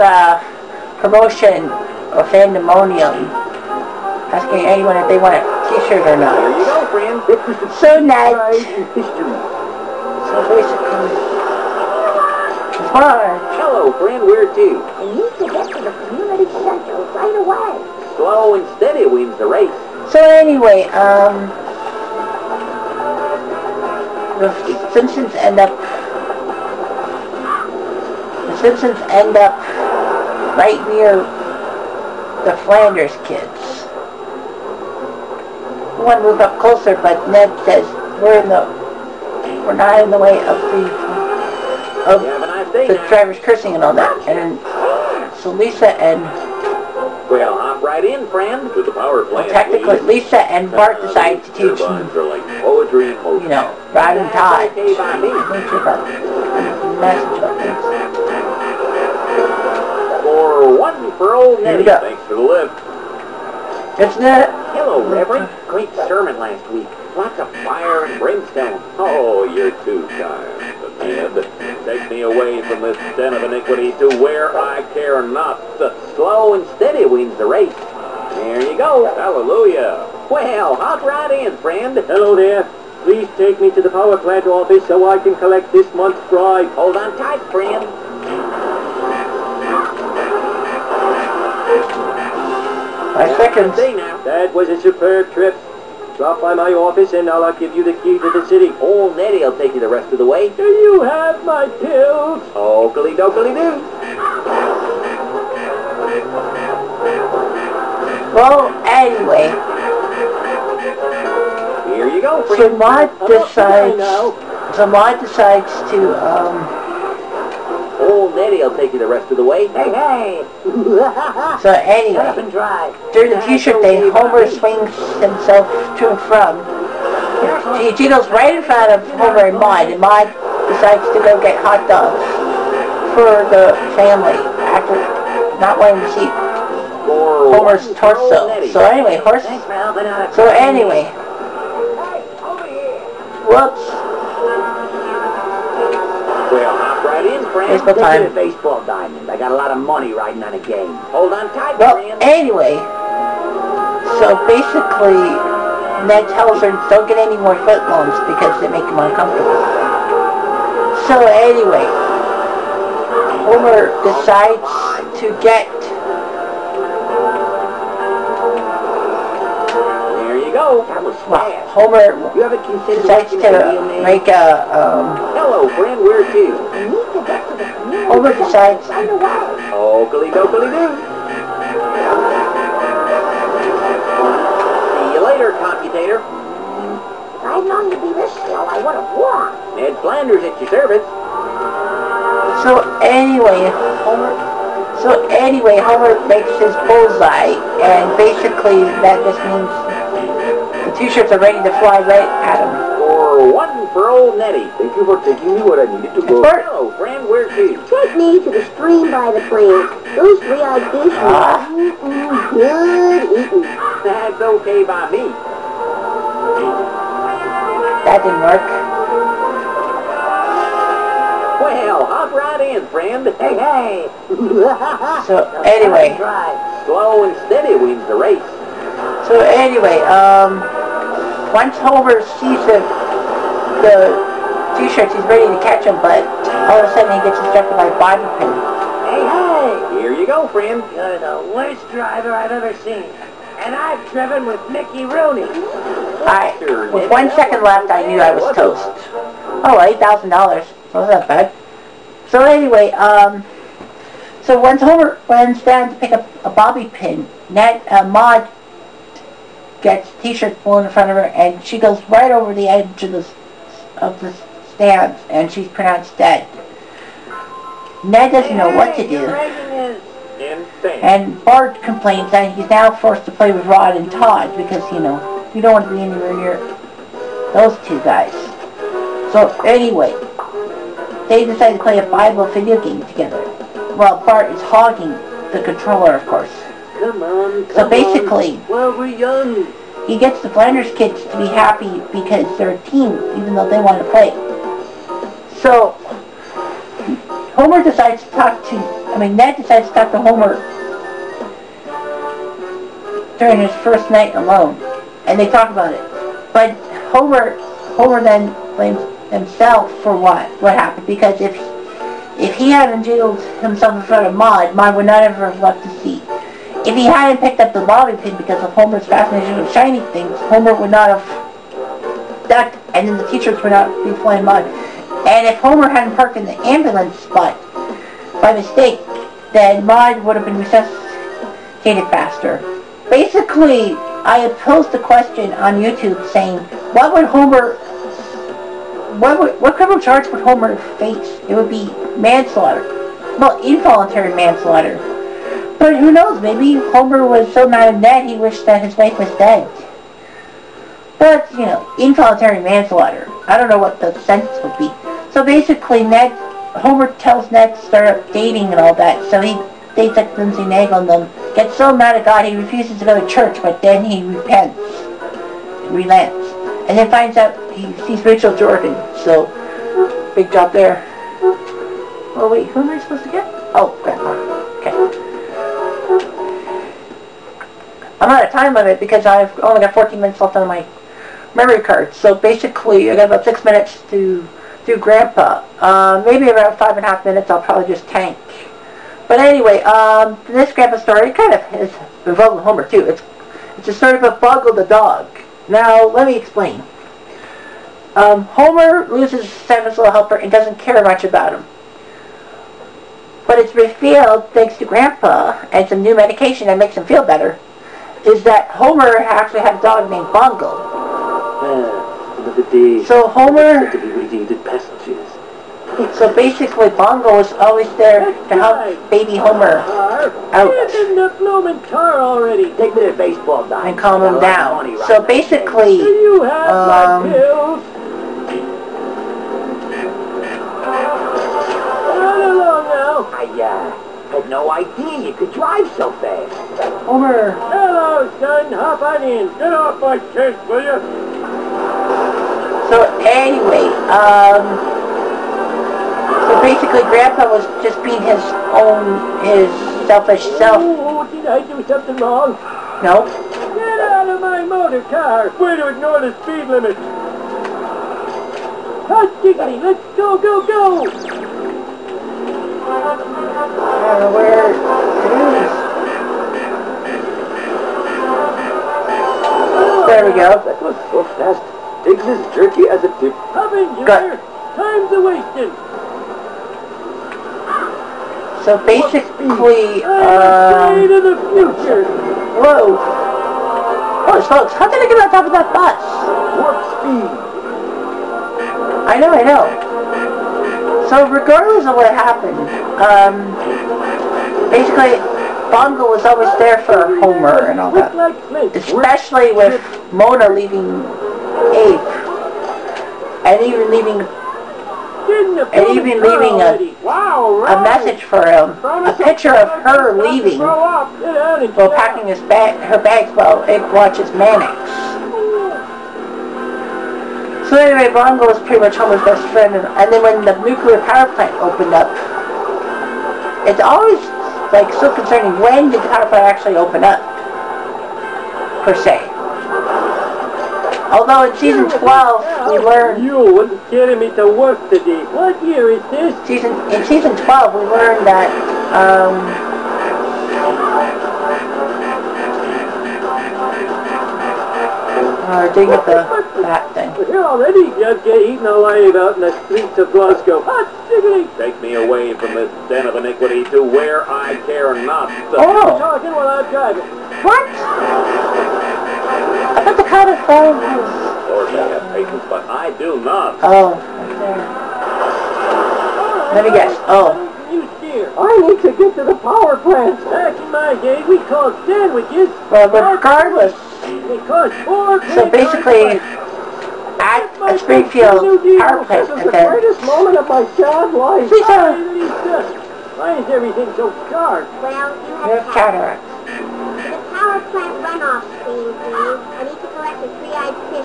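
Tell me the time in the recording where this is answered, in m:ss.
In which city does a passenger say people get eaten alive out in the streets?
9:10.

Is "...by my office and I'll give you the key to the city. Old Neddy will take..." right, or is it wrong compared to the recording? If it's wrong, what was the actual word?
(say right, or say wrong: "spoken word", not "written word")
right.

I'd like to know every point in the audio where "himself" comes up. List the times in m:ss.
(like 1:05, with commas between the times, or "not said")
2:05, 5:09, 5:13.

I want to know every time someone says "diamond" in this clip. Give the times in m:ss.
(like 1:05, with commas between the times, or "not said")
2:28, 7:03.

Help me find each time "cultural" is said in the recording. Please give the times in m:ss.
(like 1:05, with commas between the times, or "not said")
not said.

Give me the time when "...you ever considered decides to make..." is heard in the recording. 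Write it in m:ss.
2:52.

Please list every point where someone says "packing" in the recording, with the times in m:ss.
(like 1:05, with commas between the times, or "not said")
8:31.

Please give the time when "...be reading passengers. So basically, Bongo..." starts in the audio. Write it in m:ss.
6:53.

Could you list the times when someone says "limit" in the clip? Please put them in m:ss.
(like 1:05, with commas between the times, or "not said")
6:18, 7:36.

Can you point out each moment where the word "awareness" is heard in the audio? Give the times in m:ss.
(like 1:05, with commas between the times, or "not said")
not said.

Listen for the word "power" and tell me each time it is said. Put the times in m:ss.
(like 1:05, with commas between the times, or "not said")
0:48, 1:23, 8:41, 8:46, 9:29, 9:38, 9:47.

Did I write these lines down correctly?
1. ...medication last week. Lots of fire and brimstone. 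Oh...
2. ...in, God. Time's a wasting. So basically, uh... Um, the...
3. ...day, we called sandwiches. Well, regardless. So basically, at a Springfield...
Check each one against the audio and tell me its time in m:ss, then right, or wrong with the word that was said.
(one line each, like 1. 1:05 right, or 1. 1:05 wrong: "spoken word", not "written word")
1. 1:06 wrong: "sermon", not "medication"
2. 7:53 wrong: "Junior", not "God"
3. 9:31 right.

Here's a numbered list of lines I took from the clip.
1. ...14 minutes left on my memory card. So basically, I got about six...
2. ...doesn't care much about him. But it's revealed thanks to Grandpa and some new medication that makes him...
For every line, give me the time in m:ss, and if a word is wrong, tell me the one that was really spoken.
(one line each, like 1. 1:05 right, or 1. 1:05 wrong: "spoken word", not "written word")
1. 6:19 right
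2. 6:40 right.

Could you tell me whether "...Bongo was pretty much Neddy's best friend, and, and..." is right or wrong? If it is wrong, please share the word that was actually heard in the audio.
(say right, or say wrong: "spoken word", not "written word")
wrong: "Homer", not "Neddy".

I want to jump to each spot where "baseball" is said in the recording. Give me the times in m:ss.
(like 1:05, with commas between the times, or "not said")
2:28, 7:03.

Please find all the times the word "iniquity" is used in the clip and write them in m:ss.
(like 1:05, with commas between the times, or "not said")
1:13, 9:13.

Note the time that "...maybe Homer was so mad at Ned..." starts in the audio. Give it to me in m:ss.
5:46.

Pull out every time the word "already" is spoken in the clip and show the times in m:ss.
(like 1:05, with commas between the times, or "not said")
7:02, 9:07.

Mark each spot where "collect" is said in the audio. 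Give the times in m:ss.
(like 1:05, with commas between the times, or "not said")
1:25, 9:49.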